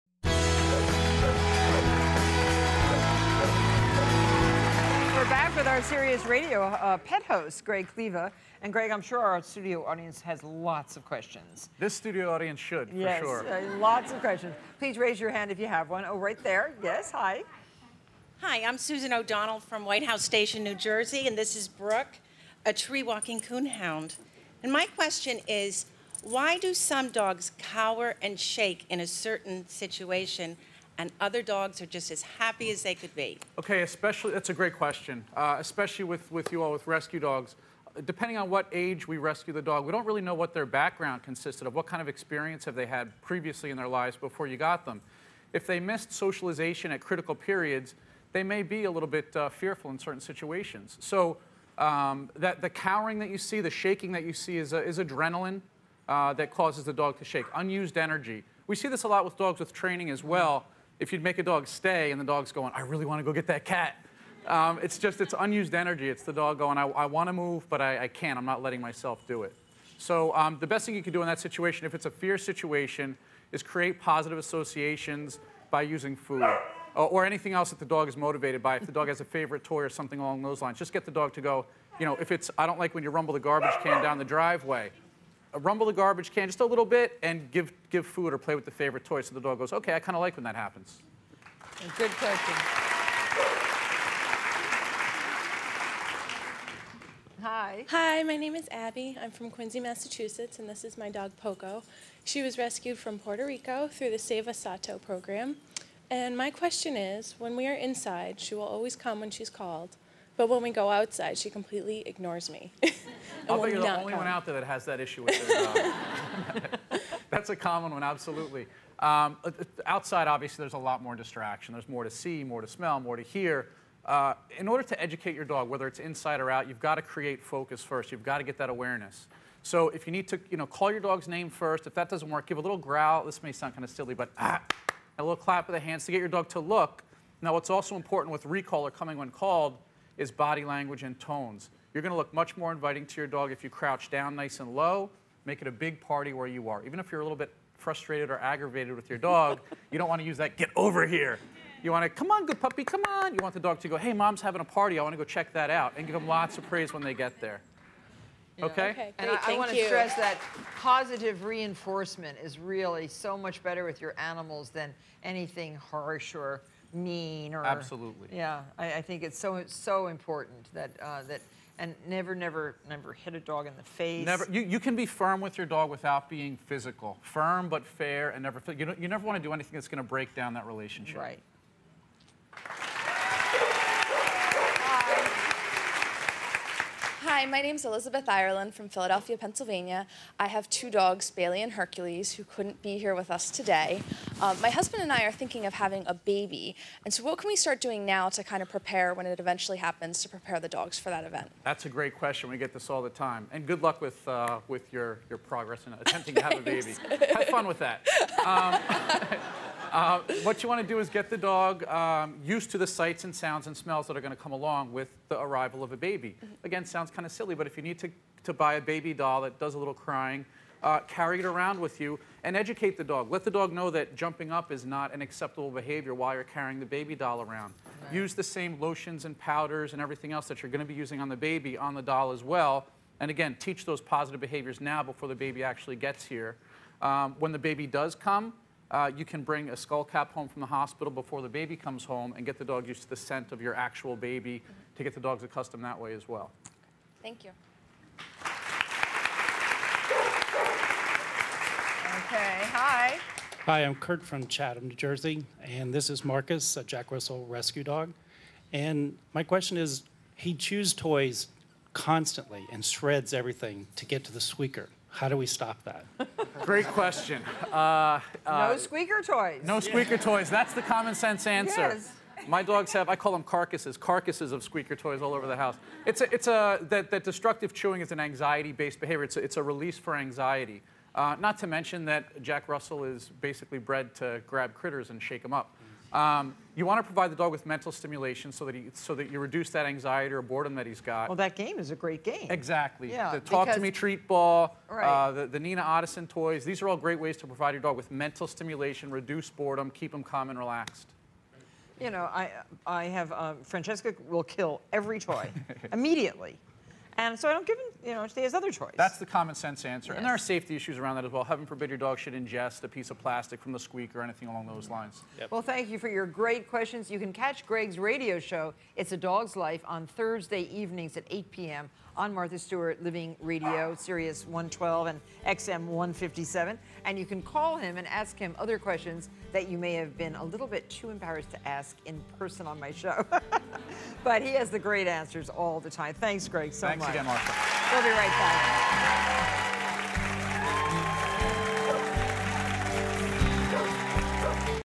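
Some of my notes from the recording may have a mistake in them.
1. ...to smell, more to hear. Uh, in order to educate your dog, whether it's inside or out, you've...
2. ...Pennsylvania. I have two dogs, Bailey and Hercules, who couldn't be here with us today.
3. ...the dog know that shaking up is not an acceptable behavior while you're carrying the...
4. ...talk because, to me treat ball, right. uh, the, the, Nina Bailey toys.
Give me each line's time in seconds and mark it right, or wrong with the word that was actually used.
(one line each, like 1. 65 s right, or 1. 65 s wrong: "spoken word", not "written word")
1. 122 s right
2. 189 s right
3. 223 s wrong: "jumping", not "shaking"
4. 293 s wrong: "Ottosson", not "Bailey".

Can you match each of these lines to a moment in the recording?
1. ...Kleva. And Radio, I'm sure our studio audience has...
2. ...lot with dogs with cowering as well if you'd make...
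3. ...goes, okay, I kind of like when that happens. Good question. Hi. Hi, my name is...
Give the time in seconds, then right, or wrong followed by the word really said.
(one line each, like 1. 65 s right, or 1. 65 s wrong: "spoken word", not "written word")
1. 7 s wrong: "Greg", not "Radio"
2. 59 s wrong: "training", not "cowering"
3. 89 s right.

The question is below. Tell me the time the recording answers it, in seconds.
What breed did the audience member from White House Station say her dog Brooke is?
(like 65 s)
22 s.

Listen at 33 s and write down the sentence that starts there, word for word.
Okay, especially, that's a great question, uh, especially with, with you all with rescue dogs.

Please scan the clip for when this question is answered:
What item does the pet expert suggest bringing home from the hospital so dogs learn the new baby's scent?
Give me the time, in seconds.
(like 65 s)
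239 s.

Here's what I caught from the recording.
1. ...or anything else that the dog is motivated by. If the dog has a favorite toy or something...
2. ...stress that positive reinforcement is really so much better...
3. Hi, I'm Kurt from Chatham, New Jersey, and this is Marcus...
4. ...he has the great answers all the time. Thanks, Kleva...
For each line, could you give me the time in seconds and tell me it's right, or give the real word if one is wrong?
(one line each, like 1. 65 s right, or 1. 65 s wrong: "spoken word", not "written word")
1. 77 s right
2. 159 s right
3. 253 s right
4. 334 s wrong: "Greg", not "Kleva".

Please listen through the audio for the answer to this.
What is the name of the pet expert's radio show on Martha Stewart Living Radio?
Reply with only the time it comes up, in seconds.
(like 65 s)
318 s.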